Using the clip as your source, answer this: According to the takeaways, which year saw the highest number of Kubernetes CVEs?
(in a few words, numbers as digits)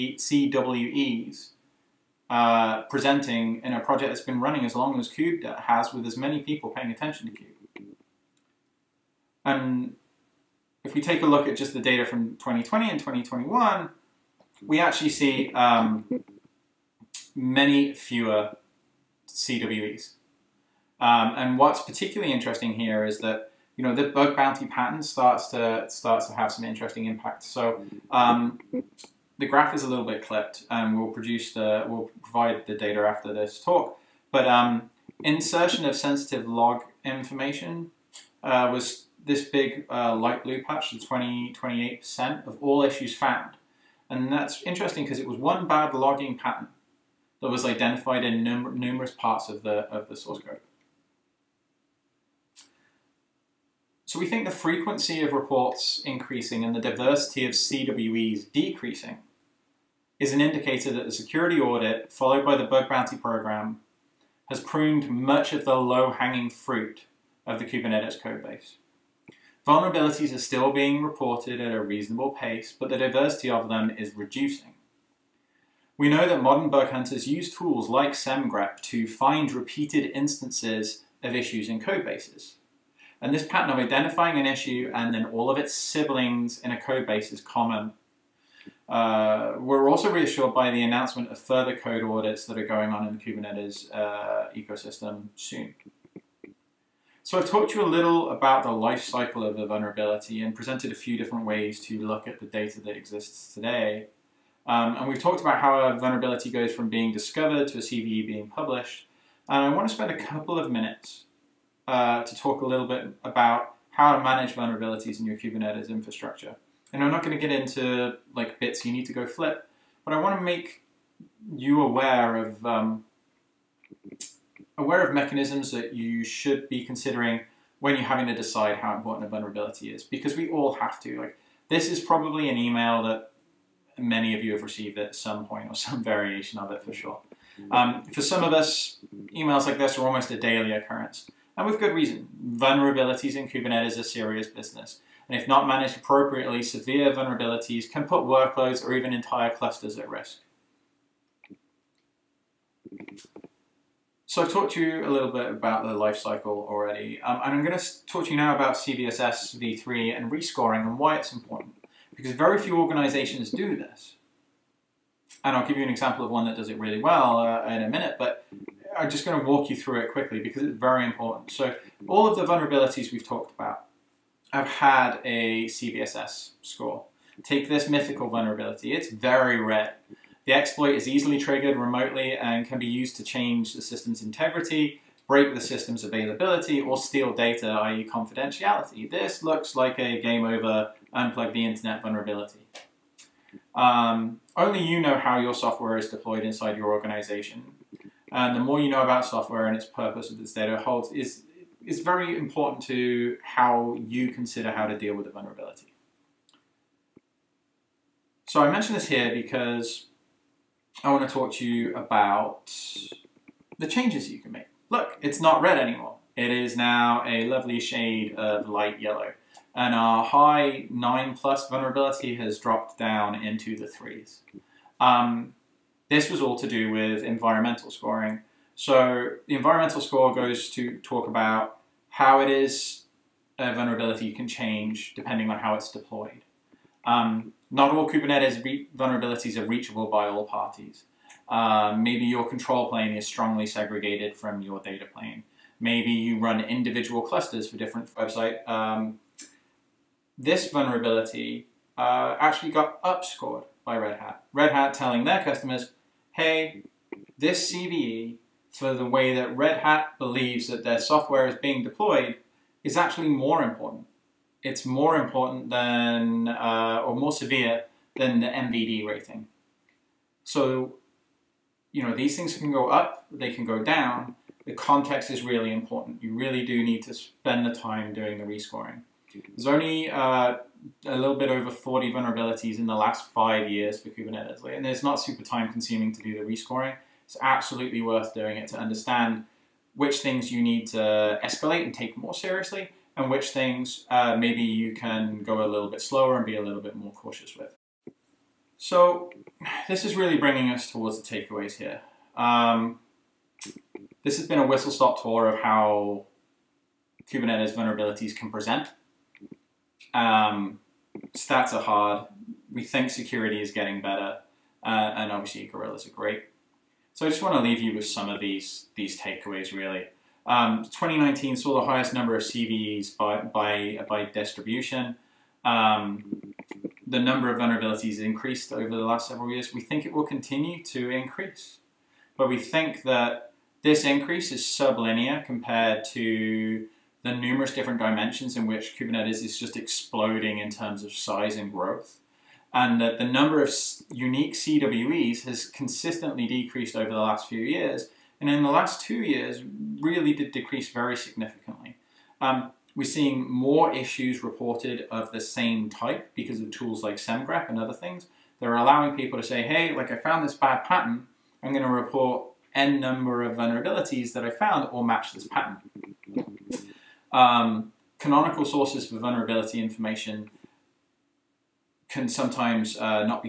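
2019.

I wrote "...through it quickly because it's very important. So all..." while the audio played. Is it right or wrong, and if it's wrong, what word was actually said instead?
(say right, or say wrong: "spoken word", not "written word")
right.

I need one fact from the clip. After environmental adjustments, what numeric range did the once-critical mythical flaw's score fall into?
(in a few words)
the 3s.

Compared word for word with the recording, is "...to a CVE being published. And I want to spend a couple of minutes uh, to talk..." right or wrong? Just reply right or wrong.
right.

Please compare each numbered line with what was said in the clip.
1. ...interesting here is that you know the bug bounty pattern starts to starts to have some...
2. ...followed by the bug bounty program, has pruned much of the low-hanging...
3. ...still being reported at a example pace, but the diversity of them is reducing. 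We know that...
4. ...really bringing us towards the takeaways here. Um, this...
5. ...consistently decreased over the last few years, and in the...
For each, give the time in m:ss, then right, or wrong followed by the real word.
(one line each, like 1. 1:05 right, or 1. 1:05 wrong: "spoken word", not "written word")
1. 0:22 right
2. 1:02 right
3. 1:10 wrong: "reasonable", not "example"
4. 5:00 right
5. 5:45 right.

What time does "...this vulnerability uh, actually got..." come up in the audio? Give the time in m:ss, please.
4:10.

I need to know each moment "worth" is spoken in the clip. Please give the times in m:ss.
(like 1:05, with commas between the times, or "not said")
4:48.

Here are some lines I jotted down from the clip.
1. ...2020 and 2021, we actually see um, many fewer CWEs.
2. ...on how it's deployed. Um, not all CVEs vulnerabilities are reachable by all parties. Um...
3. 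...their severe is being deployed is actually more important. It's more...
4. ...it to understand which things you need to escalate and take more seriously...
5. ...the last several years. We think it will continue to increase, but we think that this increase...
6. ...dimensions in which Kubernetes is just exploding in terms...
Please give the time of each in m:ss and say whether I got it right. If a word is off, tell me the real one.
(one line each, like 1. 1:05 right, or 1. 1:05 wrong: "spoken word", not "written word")
1. 0:12 right
2. 3:55 wrong: "Kubernetes", not "CVEs"
3. 4:20 wrong: "software", not "severe"
4. 4:48 right
5. 5:28 right
6. 5:37 right.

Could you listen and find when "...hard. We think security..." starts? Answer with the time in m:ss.
5:11.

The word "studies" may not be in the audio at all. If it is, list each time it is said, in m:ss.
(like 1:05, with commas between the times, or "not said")
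not said.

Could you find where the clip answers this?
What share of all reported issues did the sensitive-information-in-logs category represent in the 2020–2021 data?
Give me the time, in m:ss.
0:41.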